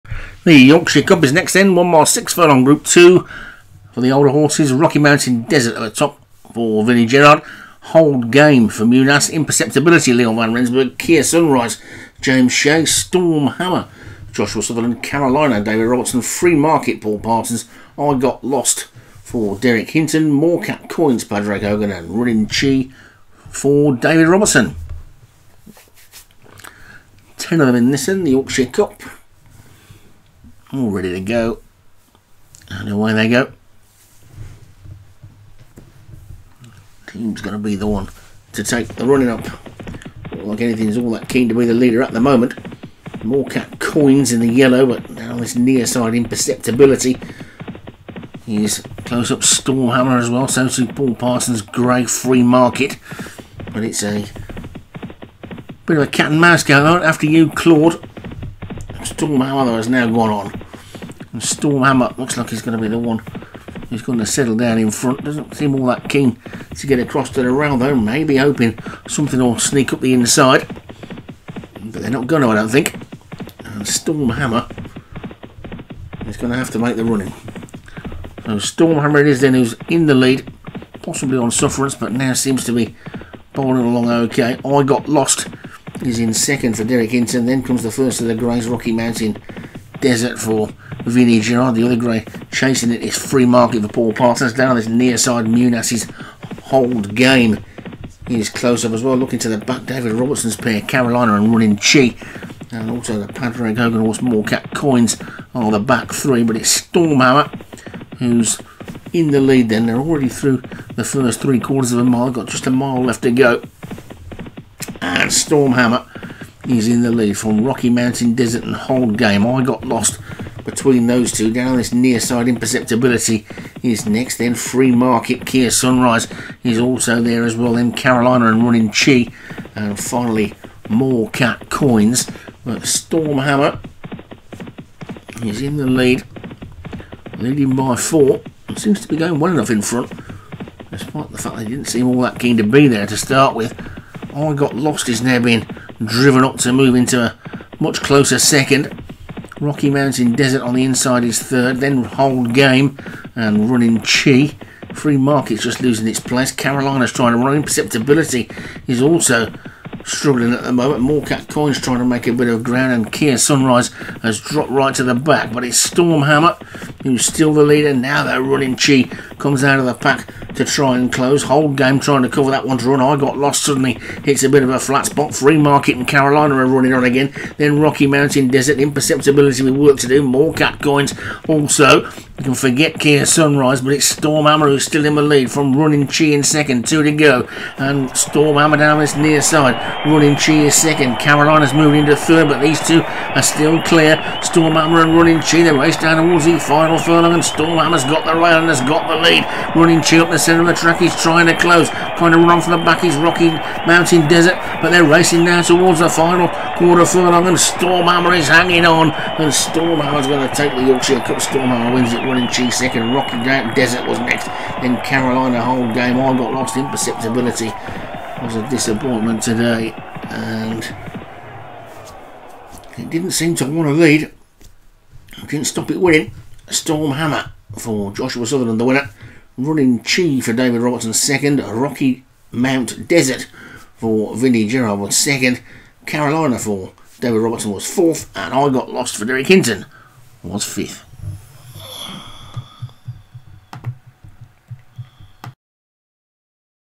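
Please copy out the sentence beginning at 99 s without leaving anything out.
David Robertson's pair, Carolina and Running Chi.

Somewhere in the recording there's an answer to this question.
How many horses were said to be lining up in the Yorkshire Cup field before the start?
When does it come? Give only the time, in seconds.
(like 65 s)
27 s.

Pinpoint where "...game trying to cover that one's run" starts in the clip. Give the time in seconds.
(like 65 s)
171 s.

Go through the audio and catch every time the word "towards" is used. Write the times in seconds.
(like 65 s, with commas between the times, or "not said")
196 s, 205 s.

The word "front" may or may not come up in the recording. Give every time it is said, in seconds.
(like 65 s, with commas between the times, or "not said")
64 s, 139 s.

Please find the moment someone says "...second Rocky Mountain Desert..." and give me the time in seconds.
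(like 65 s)
148 s.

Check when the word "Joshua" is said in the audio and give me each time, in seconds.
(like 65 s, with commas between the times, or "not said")
14 s, 228 s.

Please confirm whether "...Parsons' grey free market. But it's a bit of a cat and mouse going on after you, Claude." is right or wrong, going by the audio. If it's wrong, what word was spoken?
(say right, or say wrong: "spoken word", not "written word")
right.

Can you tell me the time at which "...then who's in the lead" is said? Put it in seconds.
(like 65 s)
79 s.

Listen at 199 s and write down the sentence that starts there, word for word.
Running Chi up the centre of the track.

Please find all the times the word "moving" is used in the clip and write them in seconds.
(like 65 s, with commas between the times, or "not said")
191 s.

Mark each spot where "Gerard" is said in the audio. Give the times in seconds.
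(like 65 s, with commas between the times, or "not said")
7 s, 91 s, 234 s.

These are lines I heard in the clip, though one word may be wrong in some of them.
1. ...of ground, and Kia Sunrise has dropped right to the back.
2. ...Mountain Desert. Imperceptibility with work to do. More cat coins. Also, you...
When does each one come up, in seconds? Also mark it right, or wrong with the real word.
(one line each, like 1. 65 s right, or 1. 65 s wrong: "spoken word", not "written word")
1. 162 s right
2. 178 s right.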